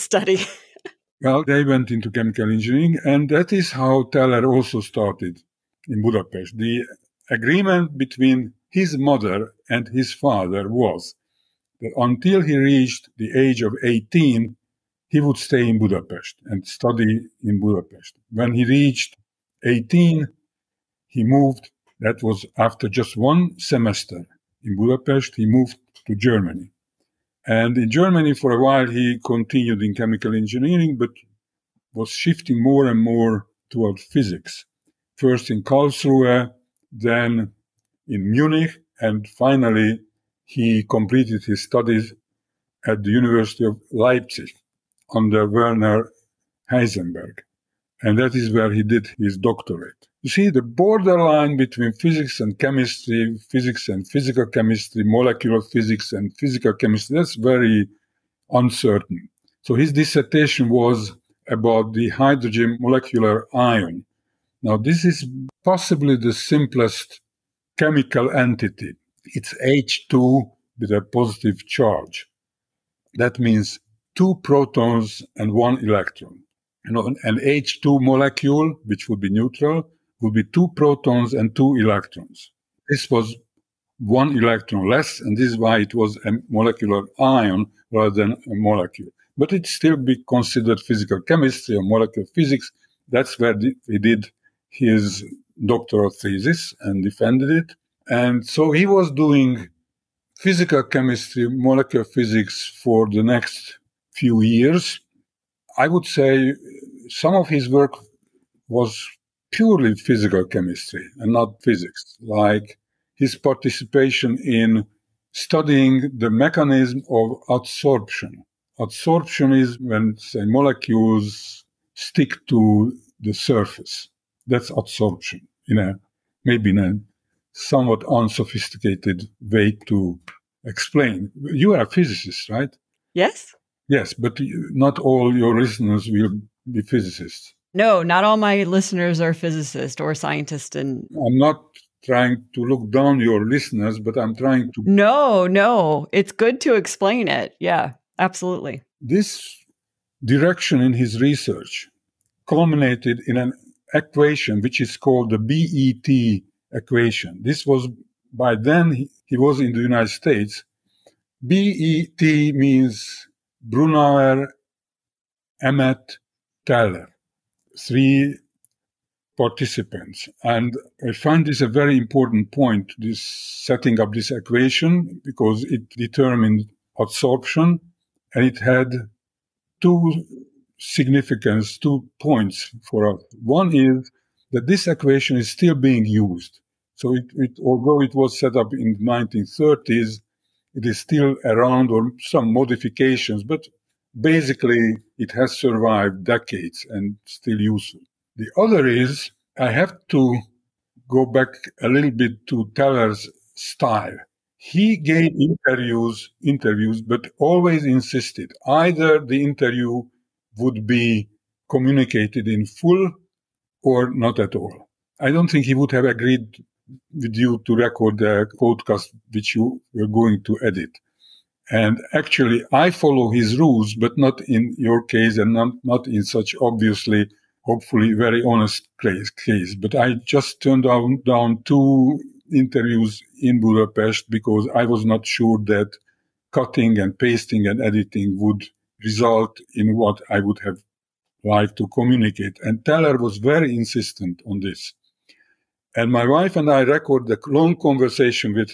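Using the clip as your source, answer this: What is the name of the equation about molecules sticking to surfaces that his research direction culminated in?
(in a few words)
BET equation.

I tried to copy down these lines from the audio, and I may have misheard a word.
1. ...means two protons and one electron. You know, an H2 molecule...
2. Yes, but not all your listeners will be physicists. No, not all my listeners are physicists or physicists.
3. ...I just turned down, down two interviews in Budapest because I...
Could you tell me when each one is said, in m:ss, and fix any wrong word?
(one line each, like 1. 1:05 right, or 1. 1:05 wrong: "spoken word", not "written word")
1. 1:13 right
2. 2:13 wrong: "scientists", not "physicists"
3. 3:49 right.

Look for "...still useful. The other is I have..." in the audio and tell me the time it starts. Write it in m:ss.
3:17.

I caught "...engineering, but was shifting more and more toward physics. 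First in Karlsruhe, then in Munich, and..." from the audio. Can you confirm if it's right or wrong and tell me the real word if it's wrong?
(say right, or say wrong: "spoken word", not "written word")
right.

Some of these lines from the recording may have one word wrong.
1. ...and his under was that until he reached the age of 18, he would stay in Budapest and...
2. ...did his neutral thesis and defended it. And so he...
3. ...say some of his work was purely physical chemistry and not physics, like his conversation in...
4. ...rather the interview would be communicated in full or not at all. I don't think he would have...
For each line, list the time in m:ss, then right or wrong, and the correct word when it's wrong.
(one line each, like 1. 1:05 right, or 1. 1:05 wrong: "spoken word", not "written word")
1. 0:09 wrong: "father", not "under"
2. 1:34 wrong: "doctoral", not "neutral"
3. 1:46 wrong: "participation", not "conversation"
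4. 3:28 wrong: "either", not "rather".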